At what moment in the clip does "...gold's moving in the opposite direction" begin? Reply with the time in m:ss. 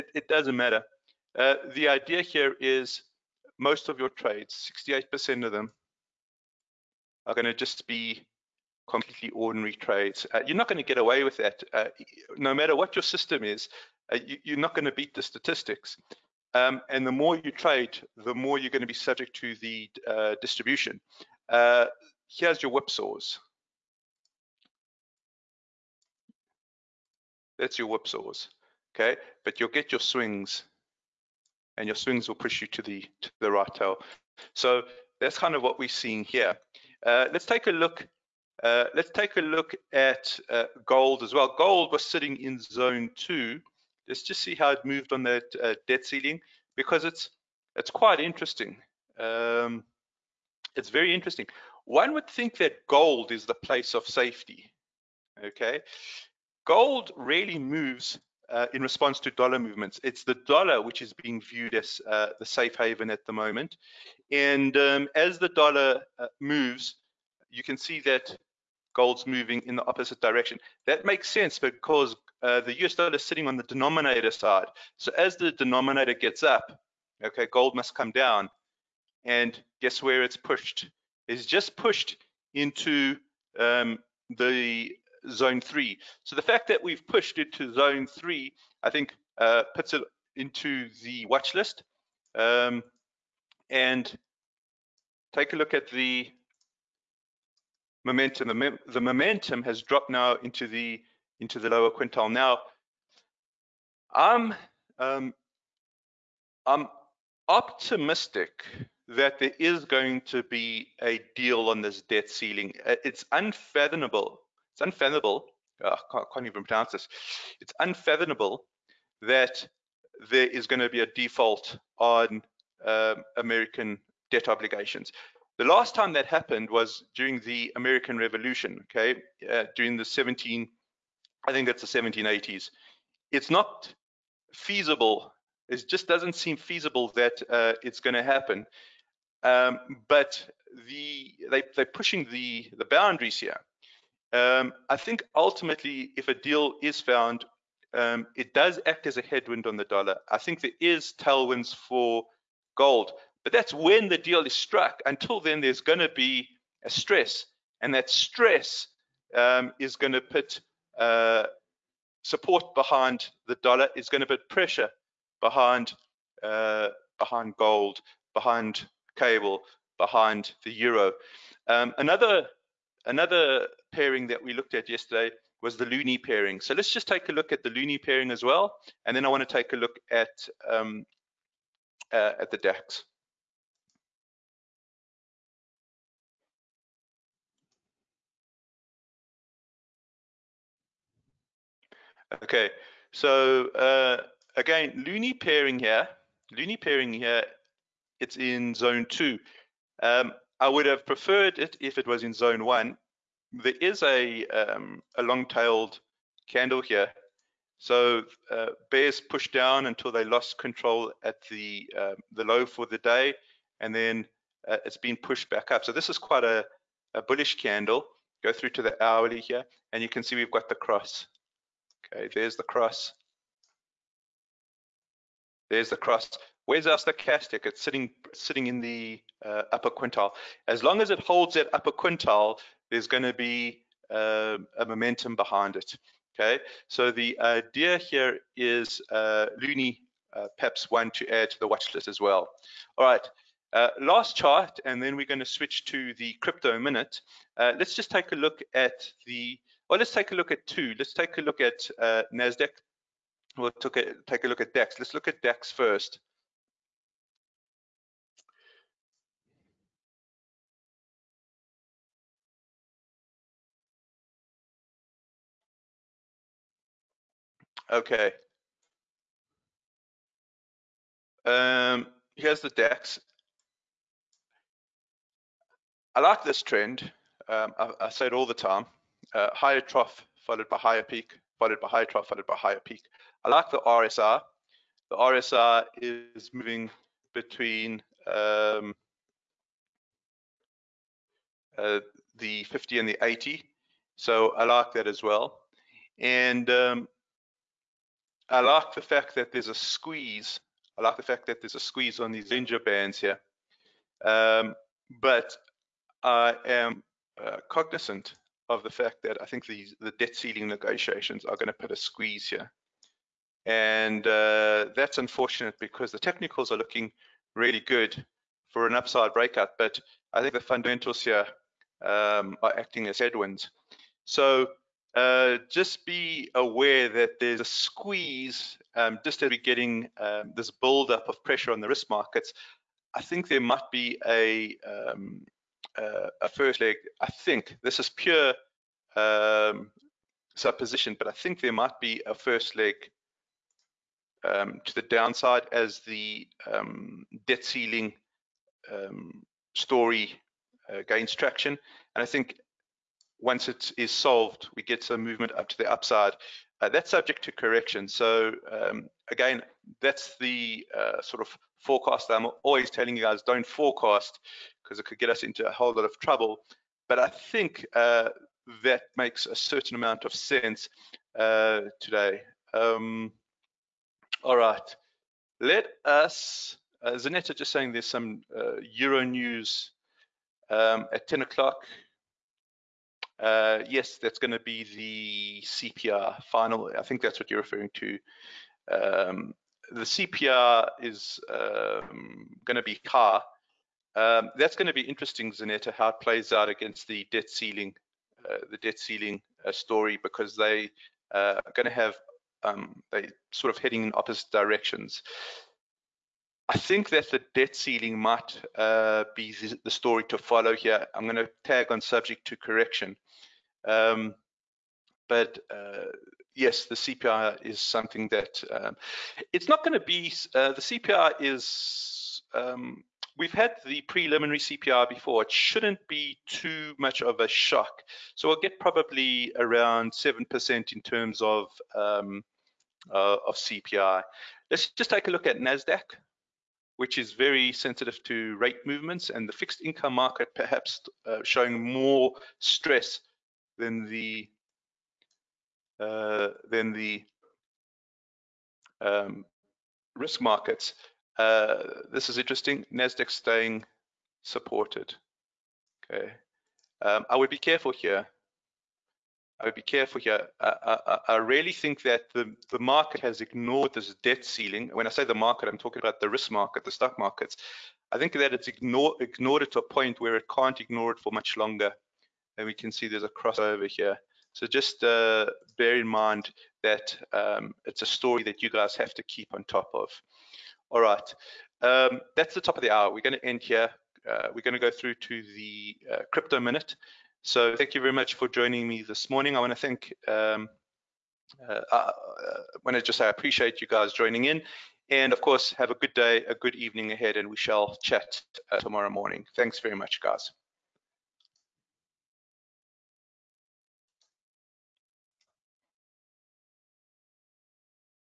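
1:08.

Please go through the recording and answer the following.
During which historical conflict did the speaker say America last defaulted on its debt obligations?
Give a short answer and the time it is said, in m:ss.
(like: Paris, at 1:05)
American Revolution, at 2:07.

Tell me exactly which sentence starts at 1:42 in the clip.
Now, I'm um, I'm optimistic that there is going to be a deal on this debt ceiling.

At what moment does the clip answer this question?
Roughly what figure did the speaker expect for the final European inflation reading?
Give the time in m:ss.
7:10.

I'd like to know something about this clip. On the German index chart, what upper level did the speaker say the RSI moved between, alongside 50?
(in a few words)
80.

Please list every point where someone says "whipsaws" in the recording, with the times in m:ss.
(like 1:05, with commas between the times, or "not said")
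0:22, 0:27.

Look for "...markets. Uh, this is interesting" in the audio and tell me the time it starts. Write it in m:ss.
7:30.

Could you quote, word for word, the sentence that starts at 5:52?
And I think once it is solved, we get some movement up to the upside.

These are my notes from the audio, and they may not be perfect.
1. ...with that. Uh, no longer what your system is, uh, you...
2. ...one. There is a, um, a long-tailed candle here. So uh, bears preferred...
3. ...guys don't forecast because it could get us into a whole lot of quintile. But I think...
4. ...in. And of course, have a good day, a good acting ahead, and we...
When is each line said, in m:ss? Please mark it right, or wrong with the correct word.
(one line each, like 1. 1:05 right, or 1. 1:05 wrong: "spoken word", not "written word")
1. 0:11 wrong: "matter", not "longer"
2. 3:22 wrong: "pushed", not "preferred"
3. 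6:03 wrong: "trouble", not "quintile"
4. 8:14 wrong: "evening", not "acting".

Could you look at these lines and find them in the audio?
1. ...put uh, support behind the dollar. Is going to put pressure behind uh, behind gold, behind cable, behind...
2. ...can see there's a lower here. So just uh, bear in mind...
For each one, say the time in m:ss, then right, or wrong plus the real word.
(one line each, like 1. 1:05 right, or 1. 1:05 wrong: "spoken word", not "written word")
1. 2:40 right
2. 7:52 wrong: "crossover", not "lower".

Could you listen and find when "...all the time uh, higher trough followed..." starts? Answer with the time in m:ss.
4:38.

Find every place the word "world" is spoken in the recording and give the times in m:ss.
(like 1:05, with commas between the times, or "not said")
not said.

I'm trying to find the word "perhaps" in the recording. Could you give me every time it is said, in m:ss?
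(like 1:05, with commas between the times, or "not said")
4:00, 7:20.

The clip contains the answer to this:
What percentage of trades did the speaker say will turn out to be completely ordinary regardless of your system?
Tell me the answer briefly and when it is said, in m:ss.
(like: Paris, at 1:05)
68%, at 0:04.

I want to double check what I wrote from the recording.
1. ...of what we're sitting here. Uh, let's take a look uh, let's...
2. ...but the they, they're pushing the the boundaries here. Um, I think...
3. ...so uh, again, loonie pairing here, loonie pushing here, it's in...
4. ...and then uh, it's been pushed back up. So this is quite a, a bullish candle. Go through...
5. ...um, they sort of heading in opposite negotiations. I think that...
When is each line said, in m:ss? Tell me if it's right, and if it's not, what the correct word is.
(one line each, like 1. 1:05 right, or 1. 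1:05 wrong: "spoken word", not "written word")
1. 0:35 wrong: "seeing", not "sitting"
2. 2:20 right
3. 3:13 wrong: "pairing", not "pushing"
4. 3:33 right
5. 6:42 wrong: "directions", not "negotiations".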